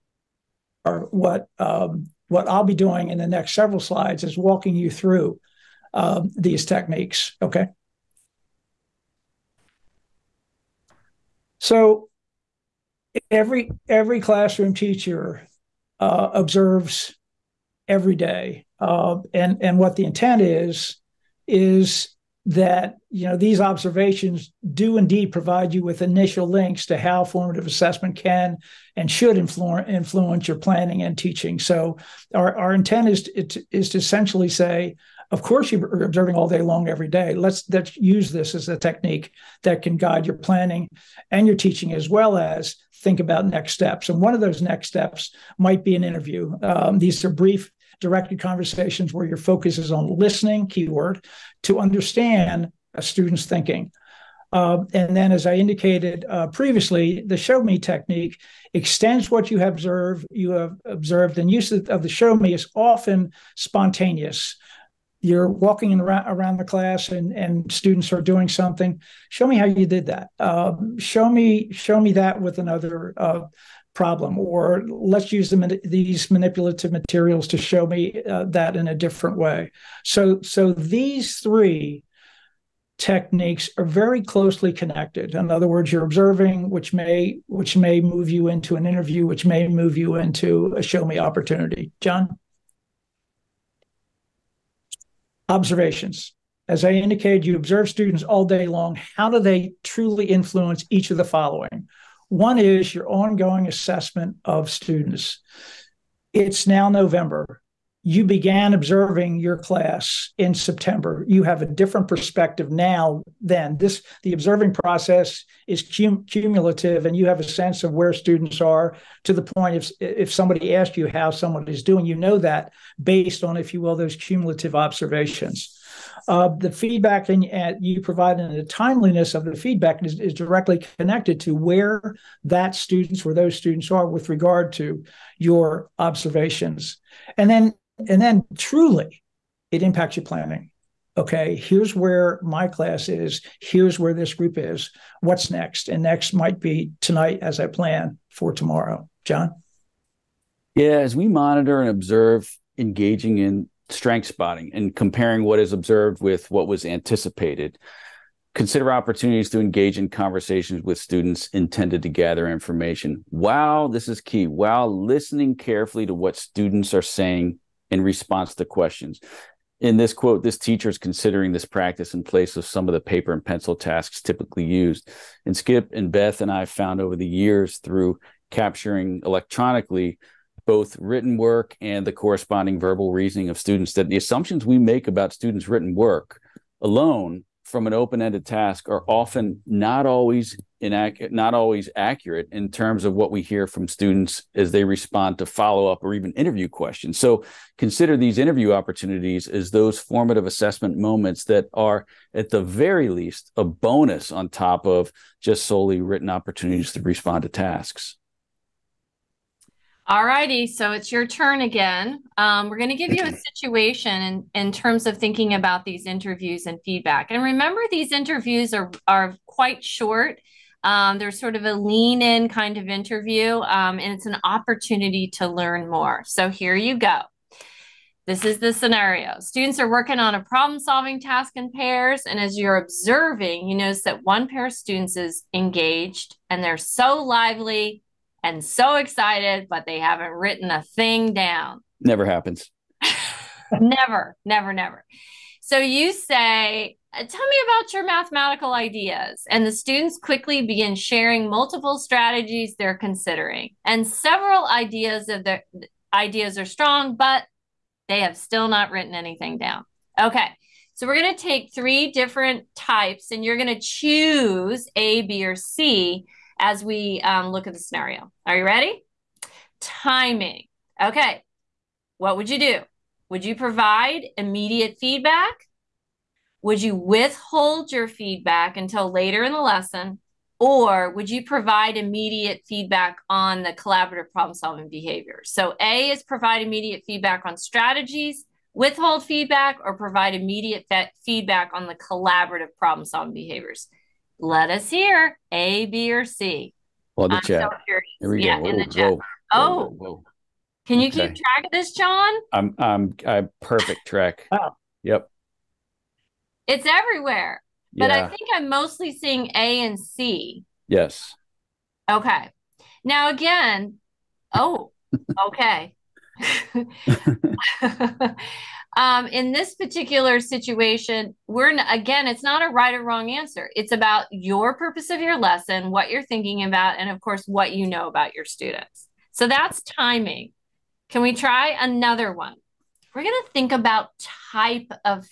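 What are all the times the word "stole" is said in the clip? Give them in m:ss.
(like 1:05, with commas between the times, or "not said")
not said.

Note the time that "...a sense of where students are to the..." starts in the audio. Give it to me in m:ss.
1:57.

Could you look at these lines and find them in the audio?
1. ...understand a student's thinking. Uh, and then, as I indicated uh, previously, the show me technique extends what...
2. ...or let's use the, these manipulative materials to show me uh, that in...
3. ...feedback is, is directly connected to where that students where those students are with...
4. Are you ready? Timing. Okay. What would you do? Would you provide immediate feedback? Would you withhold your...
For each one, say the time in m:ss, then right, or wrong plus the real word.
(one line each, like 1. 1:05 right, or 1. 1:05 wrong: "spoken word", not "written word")
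1. 0:51 right
2. 1:14 right
3. 2:09 right
4. 4:28 right.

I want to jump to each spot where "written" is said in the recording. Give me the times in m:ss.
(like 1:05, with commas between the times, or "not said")
3:00, 3:05, 3:25, 4:00, 4:18.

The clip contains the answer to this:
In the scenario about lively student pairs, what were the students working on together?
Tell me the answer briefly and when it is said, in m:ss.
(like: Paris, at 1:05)
a problem solving task, at 3:50.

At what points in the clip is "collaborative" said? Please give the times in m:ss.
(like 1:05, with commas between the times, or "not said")
4:43, 4:51.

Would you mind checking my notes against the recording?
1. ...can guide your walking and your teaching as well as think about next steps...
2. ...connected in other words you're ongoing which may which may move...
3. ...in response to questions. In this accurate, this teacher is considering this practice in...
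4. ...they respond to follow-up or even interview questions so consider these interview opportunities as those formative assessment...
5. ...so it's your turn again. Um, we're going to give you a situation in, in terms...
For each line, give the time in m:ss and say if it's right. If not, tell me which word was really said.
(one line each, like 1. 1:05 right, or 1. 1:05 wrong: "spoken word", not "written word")
1. 0:39 wrong: "planning", not "walking"
2. 1:24 wrong: "observing", not "ongoing"
3. 2:47 wrong: "quote", not "accurate"
4. 3:14 right
5. 3:30 right.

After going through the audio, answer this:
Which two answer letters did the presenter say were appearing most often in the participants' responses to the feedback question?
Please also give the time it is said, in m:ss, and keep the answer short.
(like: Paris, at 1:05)
A and C, at 5:09.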